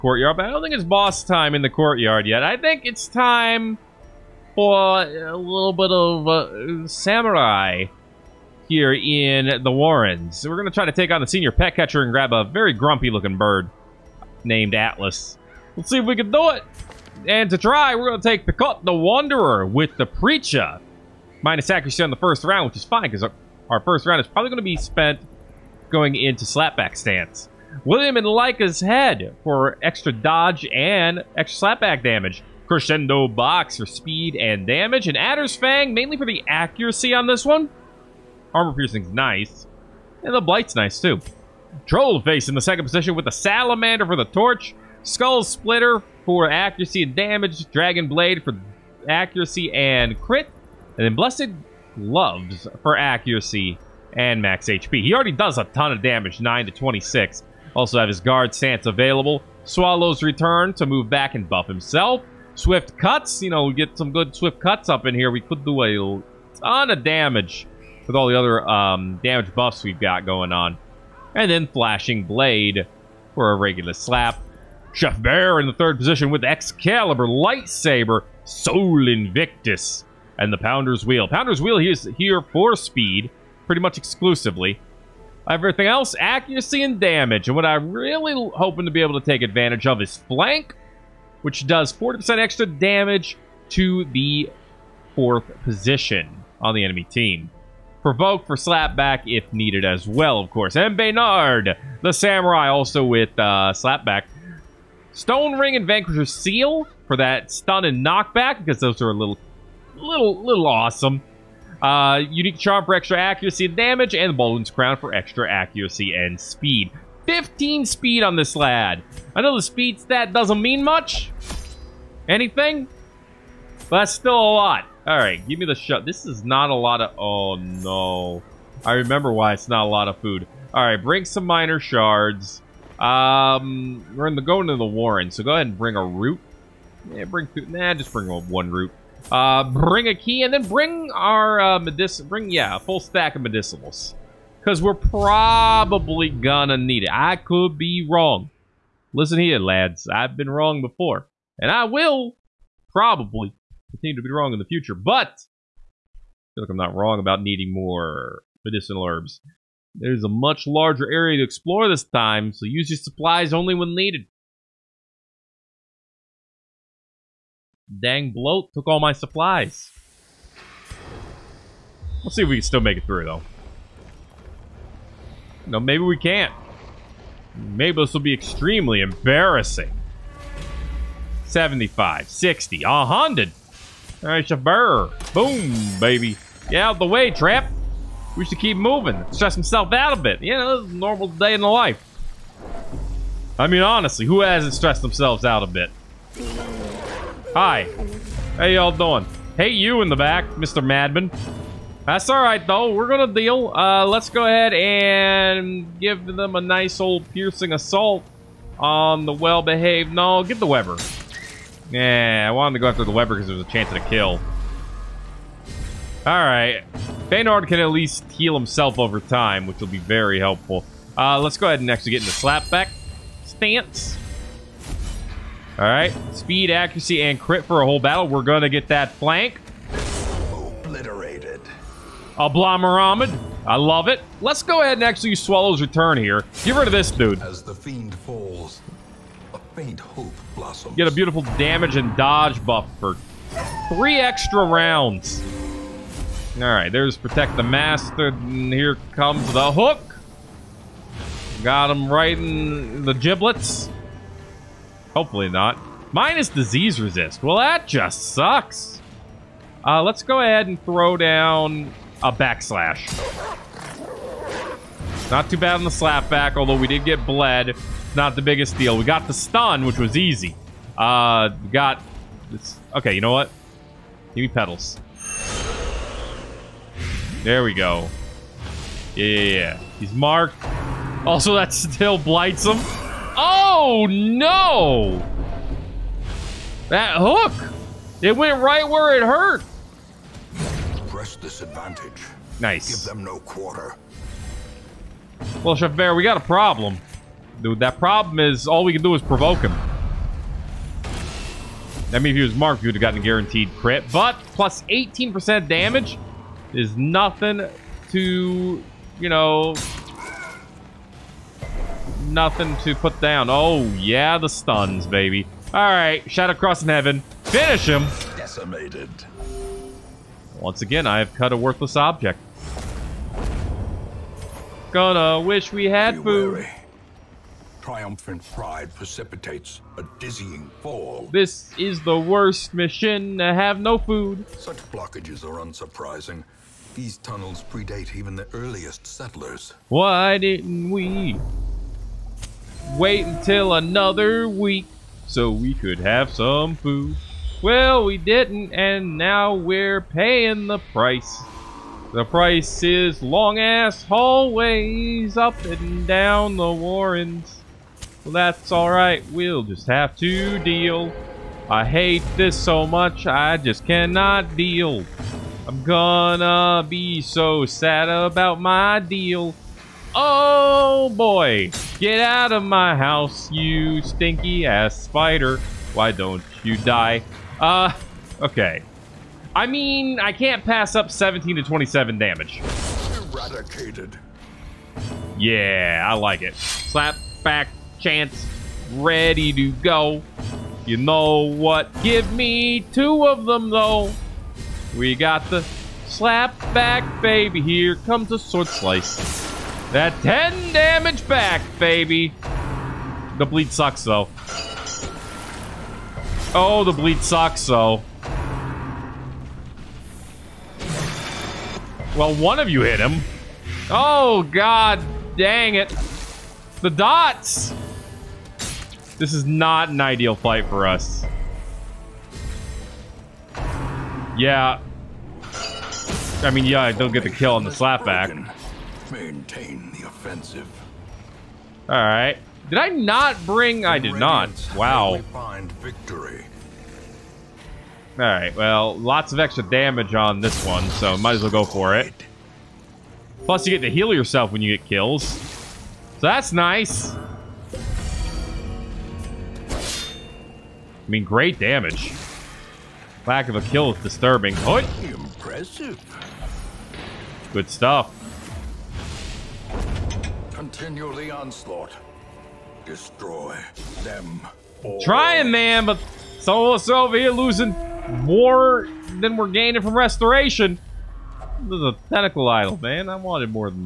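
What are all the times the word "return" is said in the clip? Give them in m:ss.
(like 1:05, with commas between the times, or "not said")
1:00, 3:55.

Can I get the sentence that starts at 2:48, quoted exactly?
Dang bloat took all my supplies.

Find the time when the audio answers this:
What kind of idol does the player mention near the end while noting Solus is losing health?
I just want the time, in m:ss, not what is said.
7:52.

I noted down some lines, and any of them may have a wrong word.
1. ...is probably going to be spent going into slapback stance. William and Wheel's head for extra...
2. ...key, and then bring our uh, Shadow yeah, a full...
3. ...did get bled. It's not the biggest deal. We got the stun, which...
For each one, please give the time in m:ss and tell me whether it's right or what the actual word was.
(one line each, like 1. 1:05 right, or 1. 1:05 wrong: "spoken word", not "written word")
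1. 0:24 wrong: "Leica", not "Wheel"
2. 2:20 wrong: "Bring", not "Shadow"
3. 4:26 right.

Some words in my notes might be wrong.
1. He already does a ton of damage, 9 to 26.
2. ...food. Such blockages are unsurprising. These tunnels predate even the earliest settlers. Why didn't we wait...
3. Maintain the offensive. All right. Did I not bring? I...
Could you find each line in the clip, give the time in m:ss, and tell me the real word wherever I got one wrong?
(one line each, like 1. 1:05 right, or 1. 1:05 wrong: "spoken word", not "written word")
1. 0:55 right
2. 5:33 right
3. 7:09 right.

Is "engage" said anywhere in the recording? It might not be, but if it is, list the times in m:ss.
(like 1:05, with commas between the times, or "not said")
not said.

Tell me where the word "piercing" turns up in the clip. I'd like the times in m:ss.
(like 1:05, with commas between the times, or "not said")
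0:38, 3:27.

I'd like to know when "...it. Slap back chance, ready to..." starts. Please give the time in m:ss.
6:26.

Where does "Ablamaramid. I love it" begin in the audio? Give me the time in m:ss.
3:52.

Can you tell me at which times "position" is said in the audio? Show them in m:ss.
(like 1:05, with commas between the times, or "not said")
0:42, 1:15, 1:35.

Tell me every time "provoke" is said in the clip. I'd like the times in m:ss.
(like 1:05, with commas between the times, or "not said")
1:38, 4:59.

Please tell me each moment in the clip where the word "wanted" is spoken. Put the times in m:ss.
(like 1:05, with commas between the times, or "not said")
3:32, 7:53.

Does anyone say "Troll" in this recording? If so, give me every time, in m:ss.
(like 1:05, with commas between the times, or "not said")
0:41.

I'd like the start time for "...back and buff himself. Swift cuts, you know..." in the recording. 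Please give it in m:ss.
1:01.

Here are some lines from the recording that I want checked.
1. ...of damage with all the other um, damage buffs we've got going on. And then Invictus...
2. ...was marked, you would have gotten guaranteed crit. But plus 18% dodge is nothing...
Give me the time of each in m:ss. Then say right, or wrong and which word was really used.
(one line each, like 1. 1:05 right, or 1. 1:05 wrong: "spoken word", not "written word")
1. 1:06 wrong: "Flashing", not "Invictus"
2. 5:02 wrong: "damage", not "dodge".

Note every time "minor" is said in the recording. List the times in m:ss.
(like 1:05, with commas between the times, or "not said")
2:11.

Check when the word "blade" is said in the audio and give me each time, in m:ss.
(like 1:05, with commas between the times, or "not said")
0:48, 1:12.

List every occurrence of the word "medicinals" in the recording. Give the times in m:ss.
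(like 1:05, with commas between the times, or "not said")
2:23, 2:38.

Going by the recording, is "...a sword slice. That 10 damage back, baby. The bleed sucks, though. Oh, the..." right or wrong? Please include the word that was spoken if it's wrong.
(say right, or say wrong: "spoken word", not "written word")
right.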